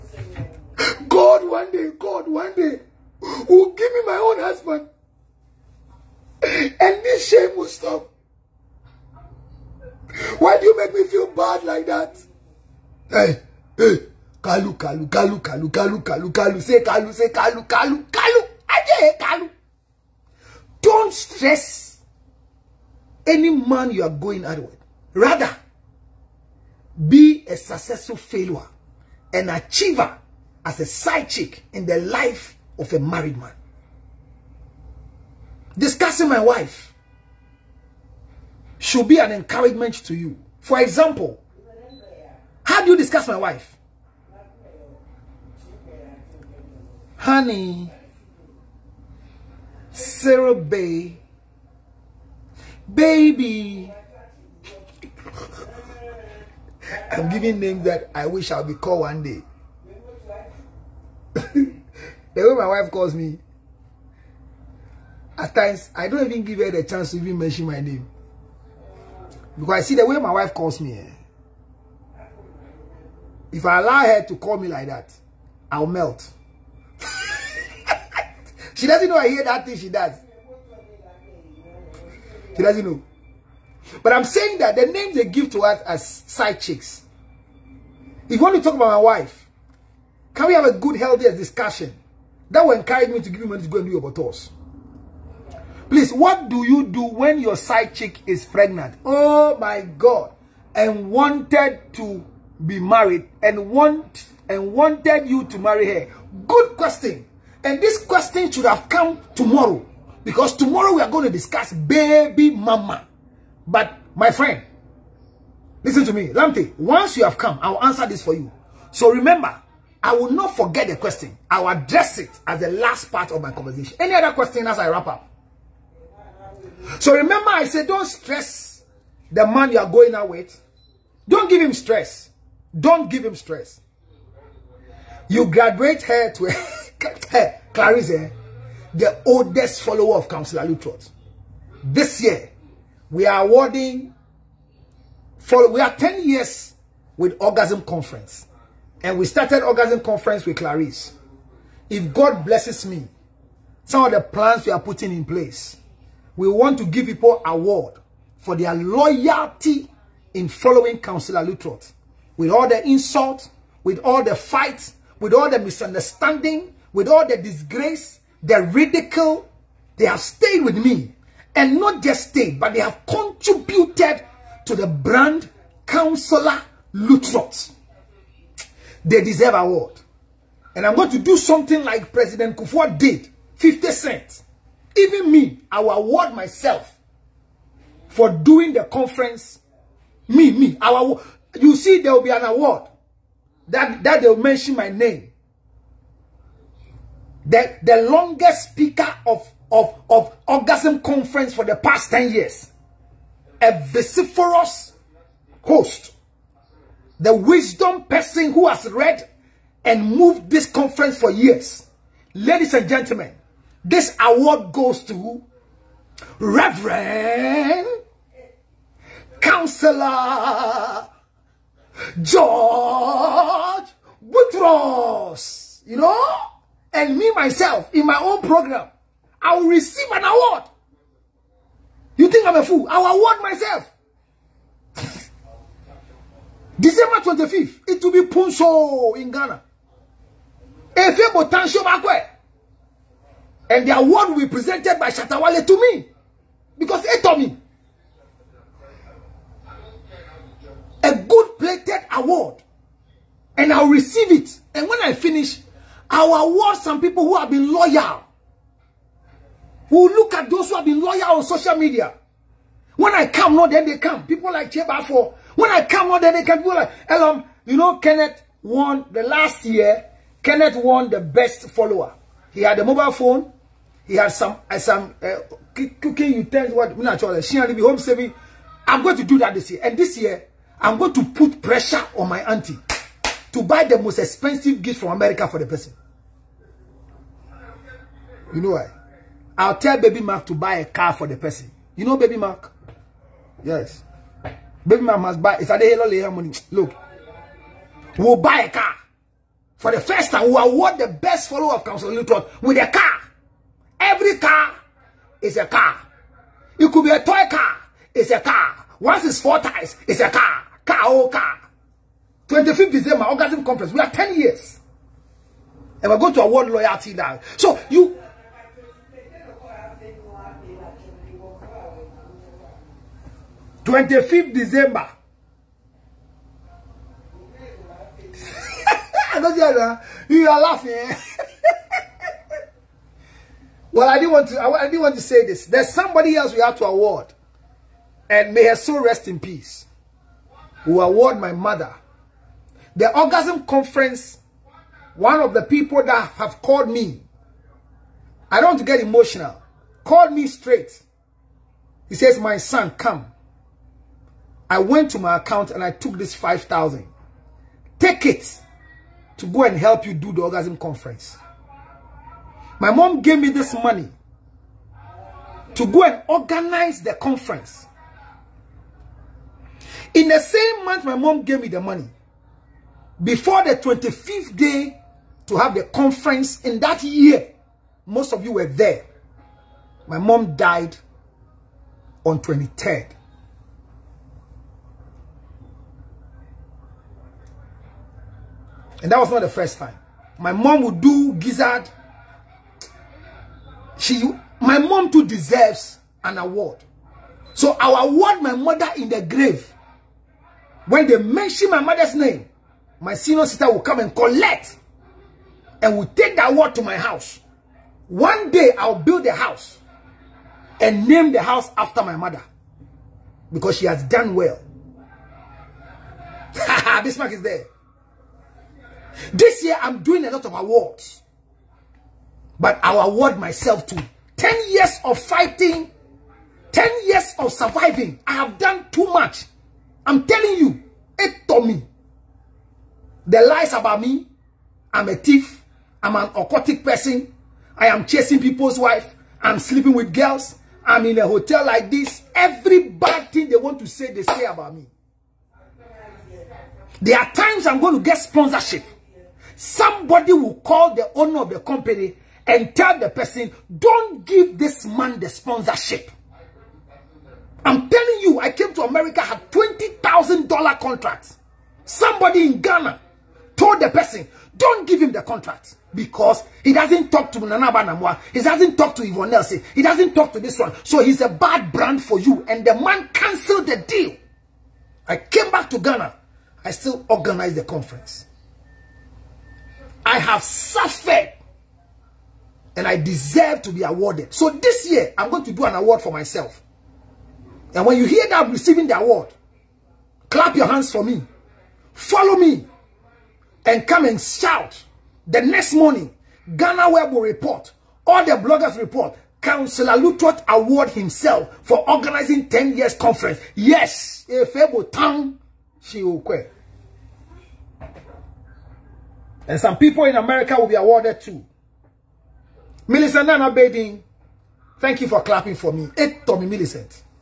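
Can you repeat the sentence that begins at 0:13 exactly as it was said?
Hey, hey, Kalu, Kalu, Kalu, Kalu, Kalu, Kalu, Kalu, say Kalu, say Kalu, Kalu, Kalu, Kalu.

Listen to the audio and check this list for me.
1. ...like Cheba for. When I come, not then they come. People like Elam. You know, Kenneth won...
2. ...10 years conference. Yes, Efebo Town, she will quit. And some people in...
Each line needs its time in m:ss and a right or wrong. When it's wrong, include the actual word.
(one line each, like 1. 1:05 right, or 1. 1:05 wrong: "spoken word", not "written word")
1. 4:24 right
2. 8:22 right.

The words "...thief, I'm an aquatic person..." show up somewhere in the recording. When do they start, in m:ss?
7:15.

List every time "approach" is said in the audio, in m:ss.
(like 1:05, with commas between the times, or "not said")
not said.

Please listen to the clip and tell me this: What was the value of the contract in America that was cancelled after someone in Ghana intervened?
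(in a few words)
$20,000.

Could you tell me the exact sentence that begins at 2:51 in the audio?
And not just stayed, but they have contributed to the brand Counselor Lutterodt.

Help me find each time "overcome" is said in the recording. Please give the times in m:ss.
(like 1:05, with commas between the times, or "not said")
not said.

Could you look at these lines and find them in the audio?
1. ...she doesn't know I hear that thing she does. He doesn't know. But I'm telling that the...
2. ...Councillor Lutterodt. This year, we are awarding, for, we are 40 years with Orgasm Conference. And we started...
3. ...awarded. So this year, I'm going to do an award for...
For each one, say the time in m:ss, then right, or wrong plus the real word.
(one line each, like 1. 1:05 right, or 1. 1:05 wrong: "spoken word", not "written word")
1. 1:18 wrong: "saying", not "telling"
2. 2:20 wrong: "10", not "40"
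3. 8:03 right.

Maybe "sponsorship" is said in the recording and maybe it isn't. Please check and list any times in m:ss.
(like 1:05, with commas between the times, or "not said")
7:28, 7:35.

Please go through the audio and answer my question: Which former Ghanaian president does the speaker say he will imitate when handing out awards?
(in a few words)
Kufuor.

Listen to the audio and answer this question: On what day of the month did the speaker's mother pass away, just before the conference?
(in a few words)
23rd.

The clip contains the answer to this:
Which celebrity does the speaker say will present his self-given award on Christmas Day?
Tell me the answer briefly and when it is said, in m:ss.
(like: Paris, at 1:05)
Shatta Wale, at 4:05.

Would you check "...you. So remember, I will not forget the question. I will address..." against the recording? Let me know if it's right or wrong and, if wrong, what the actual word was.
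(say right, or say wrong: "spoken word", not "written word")
right.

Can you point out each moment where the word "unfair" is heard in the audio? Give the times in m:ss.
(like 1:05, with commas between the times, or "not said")
not said.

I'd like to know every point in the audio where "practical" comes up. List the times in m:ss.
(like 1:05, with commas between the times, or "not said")
not said.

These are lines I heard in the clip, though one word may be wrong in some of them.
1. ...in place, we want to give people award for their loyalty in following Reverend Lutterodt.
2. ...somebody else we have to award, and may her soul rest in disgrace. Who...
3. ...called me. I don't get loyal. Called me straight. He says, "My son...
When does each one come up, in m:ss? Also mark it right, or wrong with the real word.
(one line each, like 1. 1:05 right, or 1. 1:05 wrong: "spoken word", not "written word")
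1. 2:35 wrong: "Councillor", not "Reverend"
2. 5:35 wrong: "peace", not "disgrace"
3. 5:46 wrong: "emotional", not "loyal".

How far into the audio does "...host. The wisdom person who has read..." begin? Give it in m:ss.
3:25.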